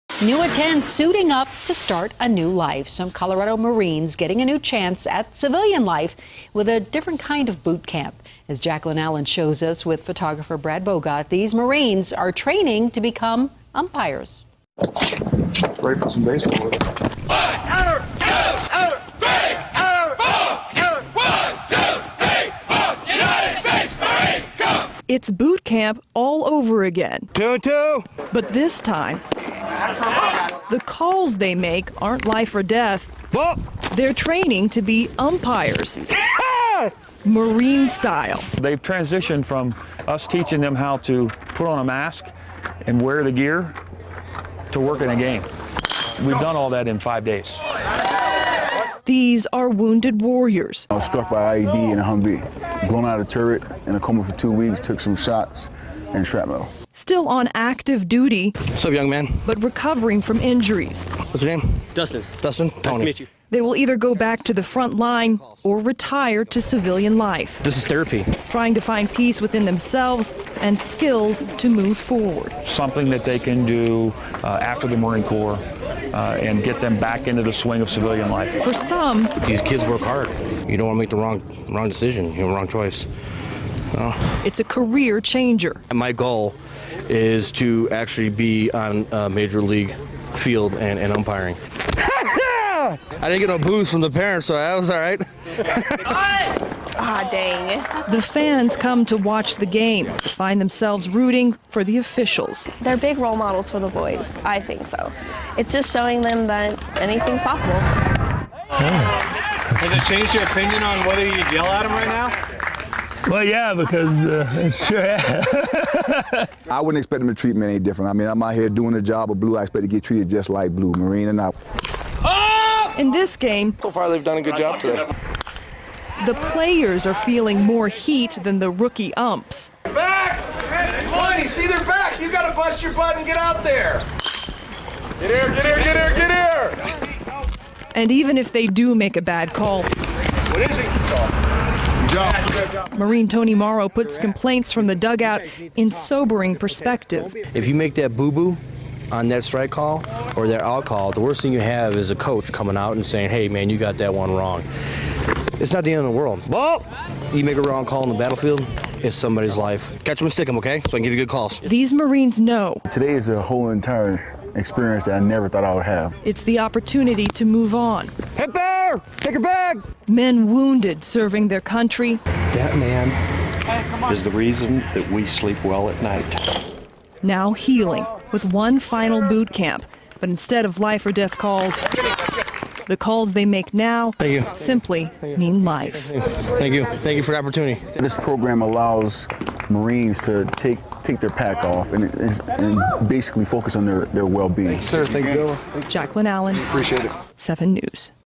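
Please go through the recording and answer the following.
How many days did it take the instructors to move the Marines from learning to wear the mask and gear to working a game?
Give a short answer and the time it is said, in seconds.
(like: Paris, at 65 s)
5, at 46 s.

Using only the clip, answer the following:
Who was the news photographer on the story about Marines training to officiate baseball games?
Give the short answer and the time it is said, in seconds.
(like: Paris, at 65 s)
Brad Bogart, at 10 s.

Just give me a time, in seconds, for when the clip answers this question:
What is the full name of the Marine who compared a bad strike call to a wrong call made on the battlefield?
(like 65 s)
143 s.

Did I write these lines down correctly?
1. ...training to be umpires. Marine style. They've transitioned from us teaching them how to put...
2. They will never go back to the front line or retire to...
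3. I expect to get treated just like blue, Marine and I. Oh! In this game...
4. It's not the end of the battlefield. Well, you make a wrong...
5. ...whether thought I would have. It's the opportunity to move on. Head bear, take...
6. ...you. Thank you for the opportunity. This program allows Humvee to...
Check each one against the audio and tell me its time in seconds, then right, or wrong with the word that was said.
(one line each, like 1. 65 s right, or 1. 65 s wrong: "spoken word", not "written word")
1. 34 s right
2. 63 s wrong: "either", not "never"
3. 119 s right
4. 155 s wrong: "world", not "battlefield"
5. 165 s wrong: "never", not "whether"
6. 186 s wrong: "Marines", not "Humvee".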